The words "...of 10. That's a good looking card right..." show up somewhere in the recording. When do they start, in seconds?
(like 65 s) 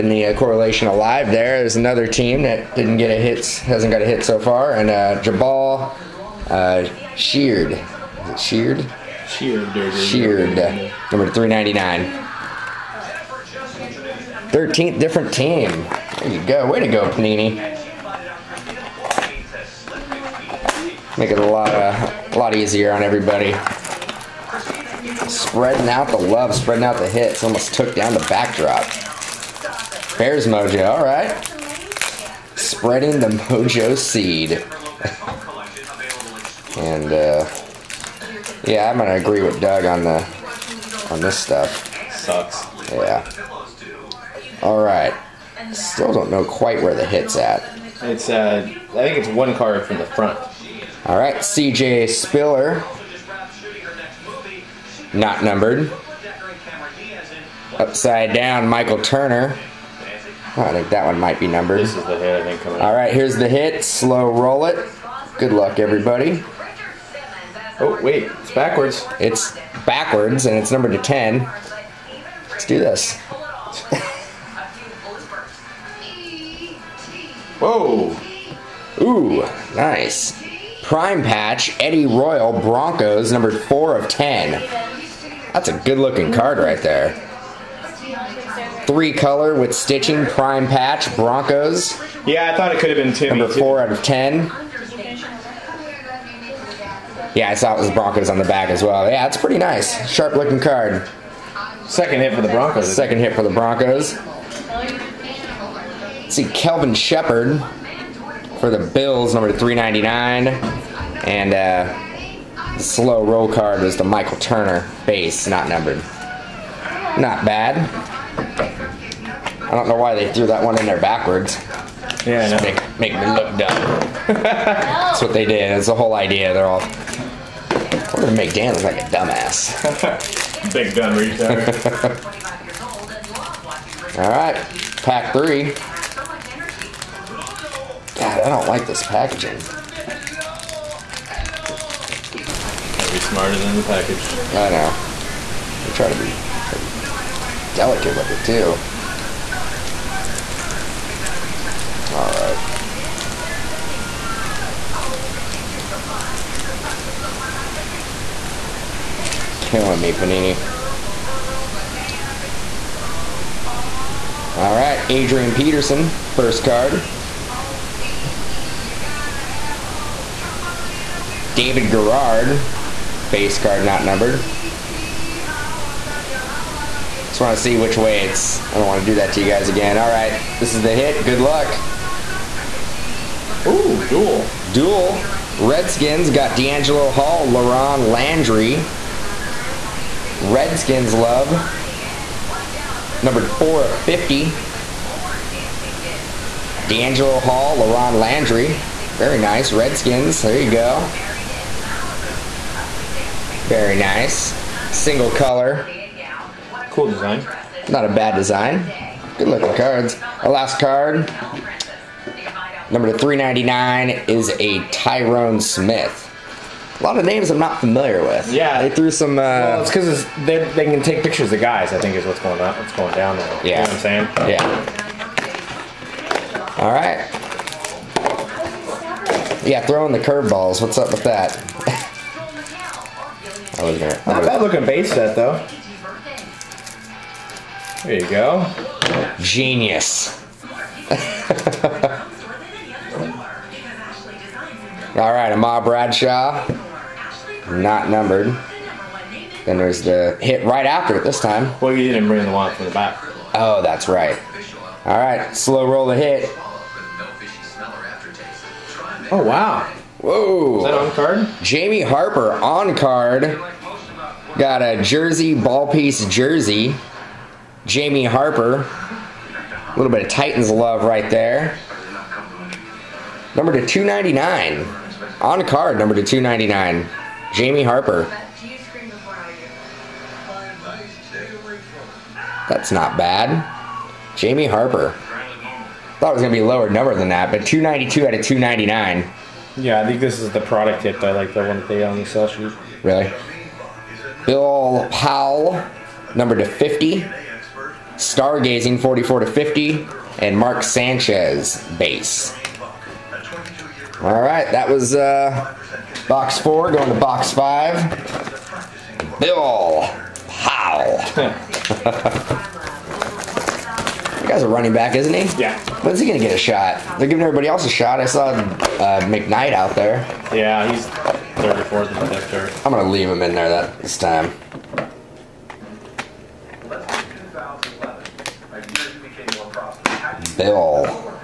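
83 s.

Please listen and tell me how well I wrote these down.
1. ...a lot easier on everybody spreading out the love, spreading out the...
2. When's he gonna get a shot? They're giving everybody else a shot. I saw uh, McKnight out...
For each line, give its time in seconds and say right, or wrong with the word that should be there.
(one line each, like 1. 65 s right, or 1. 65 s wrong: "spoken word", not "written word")
1. 22 s right
2. 316 s right.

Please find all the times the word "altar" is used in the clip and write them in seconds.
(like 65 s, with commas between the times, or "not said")
not said.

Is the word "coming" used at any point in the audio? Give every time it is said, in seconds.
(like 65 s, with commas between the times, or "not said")
62 s.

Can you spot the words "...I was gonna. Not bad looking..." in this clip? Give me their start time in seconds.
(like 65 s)
233 s.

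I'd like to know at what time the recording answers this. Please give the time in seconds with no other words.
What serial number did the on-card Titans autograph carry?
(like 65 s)
287 s.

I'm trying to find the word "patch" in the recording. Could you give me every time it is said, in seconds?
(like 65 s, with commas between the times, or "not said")
81 s, 90 s.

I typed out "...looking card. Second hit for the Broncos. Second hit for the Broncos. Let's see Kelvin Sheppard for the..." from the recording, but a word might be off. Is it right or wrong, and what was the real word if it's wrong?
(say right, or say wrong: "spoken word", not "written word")
right.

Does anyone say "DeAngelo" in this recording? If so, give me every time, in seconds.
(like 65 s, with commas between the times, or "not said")
186 s, 196 s.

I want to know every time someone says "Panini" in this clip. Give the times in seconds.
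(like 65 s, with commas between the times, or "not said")
17 s, 160 s.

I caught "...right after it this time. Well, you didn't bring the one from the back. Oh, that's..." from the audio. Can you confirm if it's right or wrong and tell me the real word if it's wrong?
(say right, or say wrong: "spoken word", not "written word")
right.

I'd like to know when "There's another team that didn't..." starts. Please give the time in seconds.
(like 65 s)
1 s.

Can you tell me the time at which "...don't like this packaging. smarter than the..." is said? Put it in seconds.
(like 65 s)
138 s.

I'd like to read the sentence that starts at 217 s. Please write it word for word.
A lot of names I'm not familiar with.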